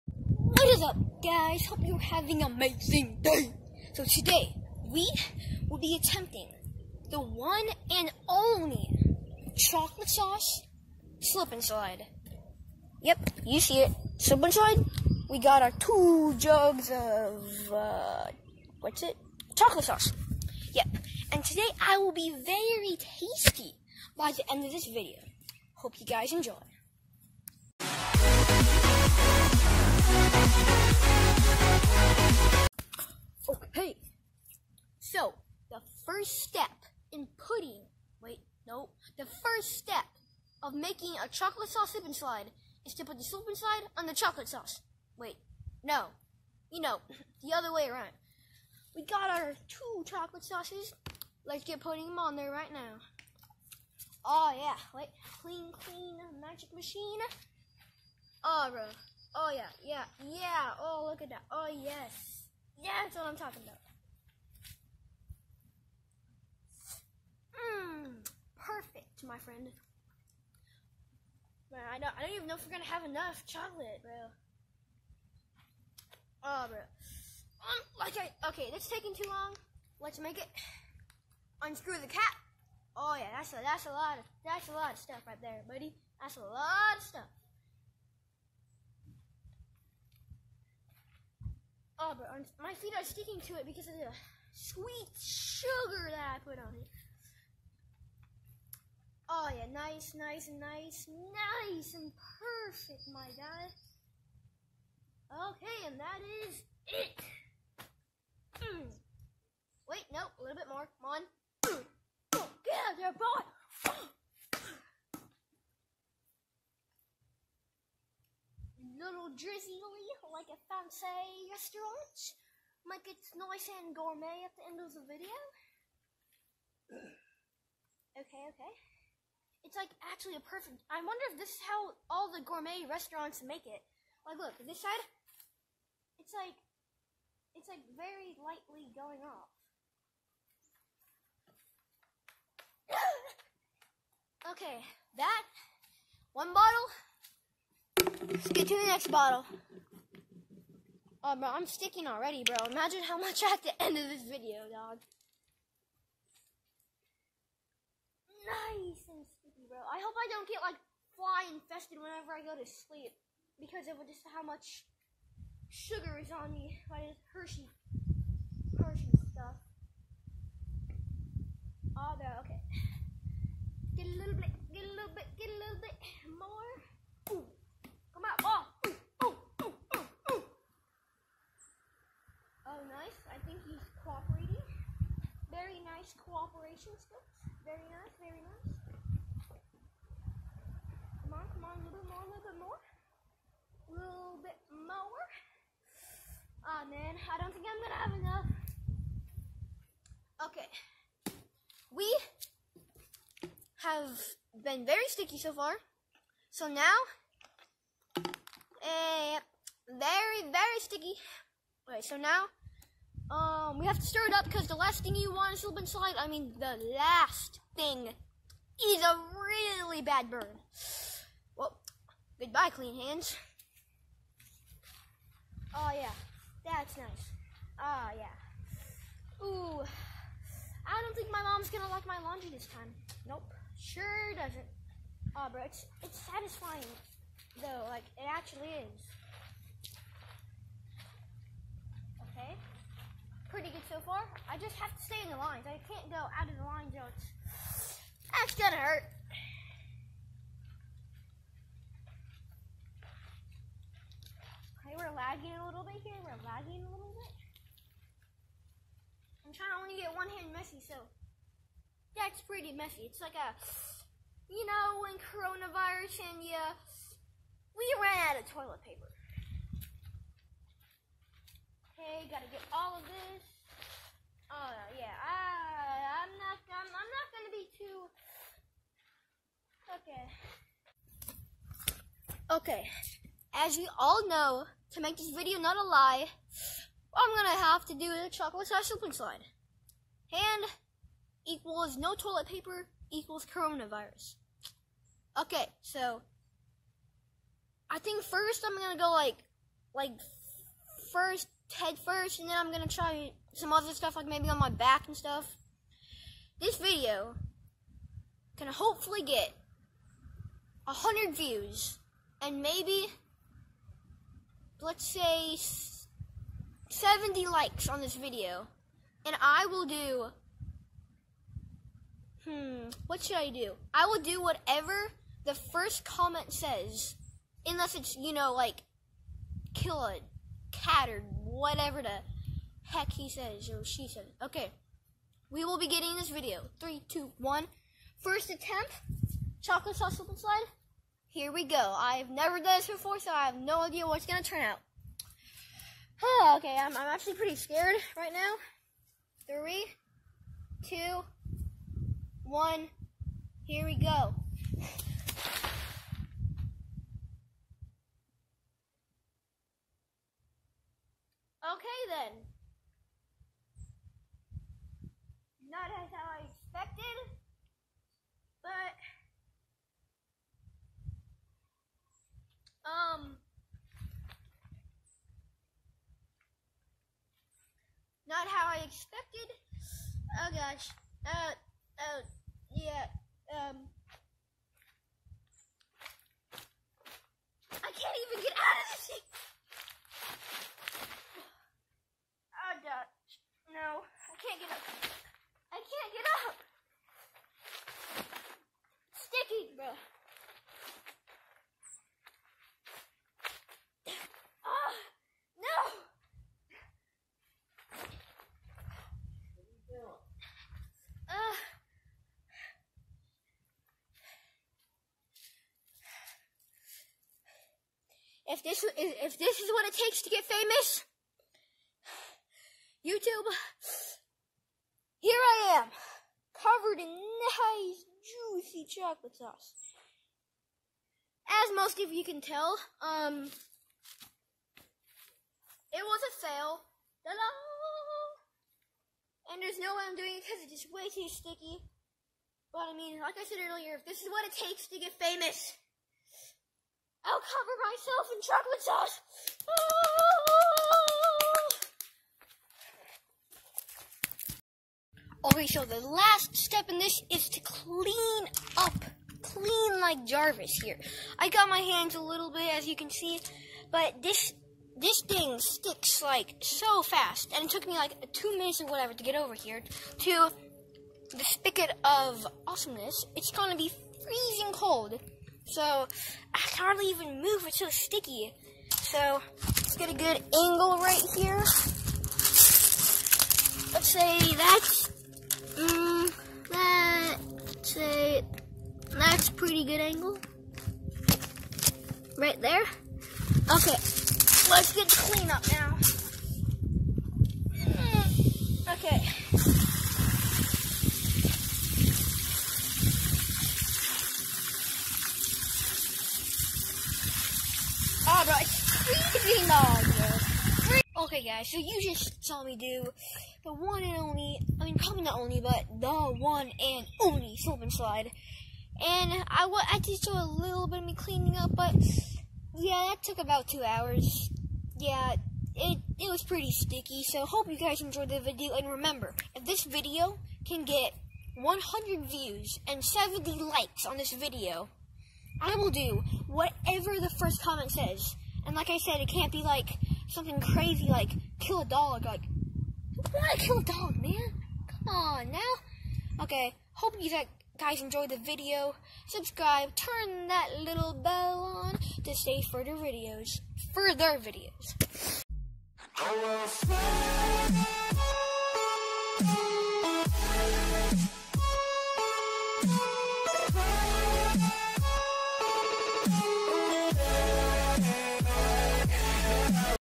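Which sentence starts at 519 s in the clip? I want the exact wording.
And I, I did show a little bit of me cleaning up, but yeah, that took about two hours.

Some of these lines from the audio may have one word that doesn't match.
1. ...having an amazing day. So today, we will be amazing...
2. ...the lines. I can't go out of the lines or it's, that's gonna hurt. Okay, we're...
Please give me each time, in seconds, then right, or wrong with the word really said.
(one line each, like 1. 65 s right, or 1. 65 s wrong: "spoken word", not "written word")
1. 1 s wrong: "attempting", not "amazing"
2. 245 s right.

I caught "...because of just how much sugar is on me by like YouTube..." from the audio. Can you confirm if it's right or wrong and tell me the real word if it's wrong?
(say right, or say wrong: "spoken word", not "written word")
wrong: "Hershey", not "YouTube".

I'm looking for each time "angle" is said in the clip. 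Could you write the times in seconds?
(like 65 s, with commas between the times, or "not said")
480 s, 490 s.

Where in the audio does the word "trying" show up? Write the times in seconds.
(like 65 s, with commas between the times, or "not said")
259 s.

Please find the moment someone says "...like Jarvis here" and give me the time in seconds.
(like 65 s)
459 s.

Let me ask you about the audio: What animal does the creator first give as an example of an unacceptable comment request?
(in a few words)
cat.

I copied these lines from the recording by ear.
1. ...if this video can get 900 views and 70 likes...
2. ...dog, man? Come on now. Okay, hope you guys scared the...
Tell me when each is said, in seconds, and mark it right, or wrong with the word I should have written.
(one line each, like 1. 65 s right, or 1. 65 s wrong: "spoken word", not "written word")
1. 529 s wrong: "100", not "900"
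2. 543 s wrong: "enjoyed", not "scared".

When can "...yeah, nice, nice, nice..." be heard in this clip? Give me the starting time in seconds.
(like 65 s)
99 s.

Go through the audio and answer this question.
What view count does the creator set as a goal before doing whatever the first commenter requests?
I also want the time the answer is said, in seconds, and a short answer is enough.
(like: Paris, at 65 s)
100, at 310 s.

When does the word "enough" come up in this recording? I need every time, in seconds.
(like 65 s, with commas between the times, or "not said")
73 s, 198 s.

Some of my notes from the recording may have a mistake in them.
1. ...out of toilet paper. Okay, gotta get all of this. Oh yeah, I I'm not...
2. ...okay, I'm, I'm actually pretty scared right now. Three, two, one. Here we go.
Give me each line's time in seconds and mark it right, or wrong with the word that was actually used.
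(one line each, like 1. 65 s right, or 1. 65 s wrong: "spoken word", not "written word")
1. 268 s right
2. 346 s right.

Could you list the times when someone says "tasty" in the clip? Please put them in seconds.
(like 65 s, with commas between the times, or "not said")
22 s.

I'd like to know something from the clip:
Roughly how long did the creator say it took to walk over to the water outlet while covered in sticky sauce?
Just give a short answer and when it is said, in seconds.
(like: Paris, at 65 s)
2 minutes, at 468 s.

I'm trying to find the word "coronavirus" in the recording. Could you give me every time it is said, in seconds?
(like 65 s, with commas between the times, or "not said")
265 s, 293 s.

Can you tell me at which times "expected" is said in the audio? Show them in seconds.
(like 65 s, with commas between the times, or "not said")
366 s, 378 s.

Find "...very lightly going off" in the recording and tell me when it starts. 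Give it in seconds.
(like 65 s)
137 s.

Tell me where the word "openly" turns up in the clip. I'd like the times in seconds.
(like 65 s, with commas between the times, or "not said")
not said.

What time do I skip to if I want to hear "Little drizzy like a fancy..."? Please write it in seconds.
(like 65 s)
119 s.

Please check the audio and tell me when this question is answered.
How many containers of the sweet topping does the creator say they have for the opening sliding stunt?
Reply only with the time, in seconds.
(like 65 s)
15 s.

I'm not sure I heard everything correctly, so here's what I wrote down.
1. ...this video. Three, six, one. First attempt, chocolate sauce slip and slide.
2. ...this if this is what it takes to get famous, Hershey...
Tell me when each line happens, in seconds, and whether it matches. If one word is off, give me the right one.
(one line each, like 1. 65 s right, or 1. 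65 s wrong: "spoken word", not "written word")
1. 336 s wrong: "two", not "six"
2. 418 s wrong: "YouTube", not "Hershey".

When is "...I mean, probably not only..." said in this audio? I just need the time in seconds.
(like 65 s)
514 s.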